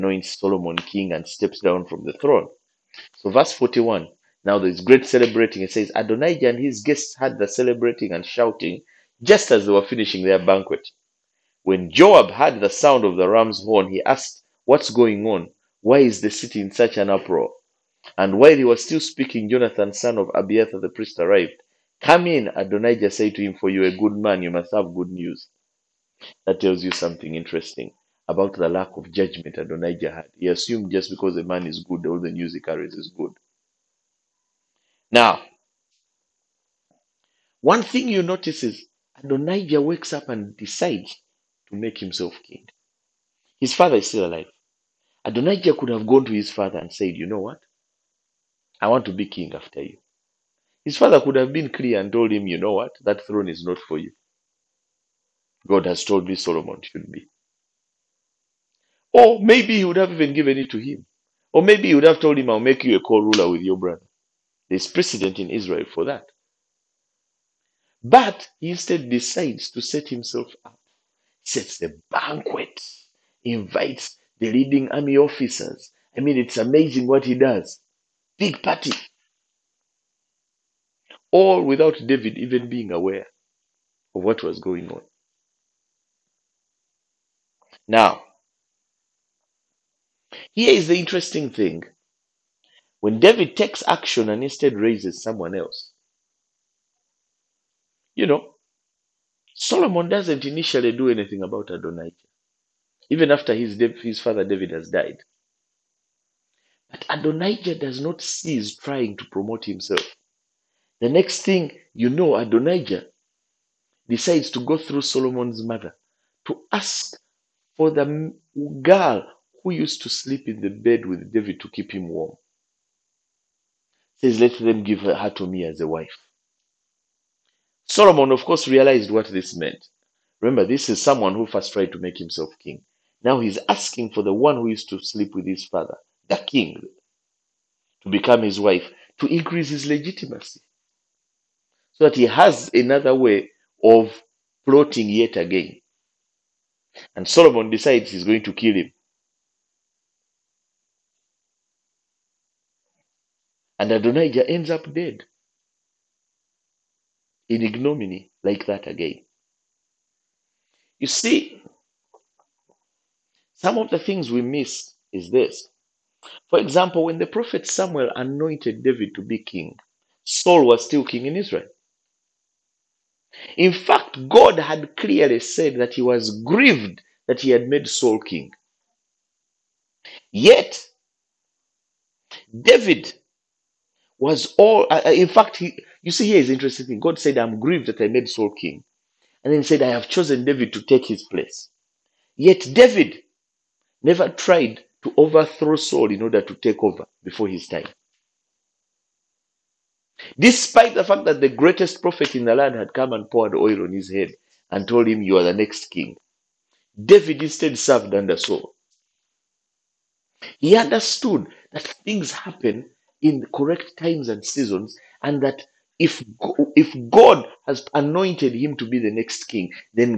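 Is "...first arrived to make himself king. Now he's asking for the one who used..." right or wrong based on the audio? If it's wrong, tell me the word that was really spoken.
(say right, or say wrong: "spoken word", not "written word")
wrong: "tried", not "arrived".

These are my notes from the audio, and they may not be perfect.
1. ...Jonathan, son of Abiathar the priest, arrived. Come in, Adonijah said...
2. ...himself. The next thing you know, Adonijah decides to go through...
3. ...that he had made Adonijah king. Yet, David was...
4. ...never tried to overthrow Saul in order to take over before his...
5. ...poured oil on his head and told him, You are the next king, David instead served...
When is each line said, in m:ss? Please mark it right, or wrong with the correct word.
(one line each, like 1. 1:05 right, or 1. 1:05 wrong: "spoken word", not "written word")
1. 0:19 right
2. 1:49 right
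3. 2:57 wrong: "Saul", not "Adonijah"
4. 3:14 right
5. 3:23 right.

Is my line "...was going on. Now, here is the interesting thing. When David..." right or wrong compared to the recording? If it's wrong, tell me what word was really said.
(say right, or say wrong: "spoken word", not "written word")
right.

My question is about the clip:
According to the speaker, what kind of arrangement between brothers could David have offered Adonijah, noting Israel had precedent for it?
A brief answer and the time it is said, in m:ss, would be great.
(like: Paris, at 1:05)
co ruler, at 1:03.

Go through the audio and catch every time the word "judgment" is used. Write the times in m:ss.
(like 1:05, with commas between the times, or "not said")
0:29.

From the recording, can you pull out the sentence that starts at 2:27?
And Solomon decides he's going to kill him.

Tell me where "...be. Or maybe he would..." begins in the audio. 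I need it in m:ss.
0:57.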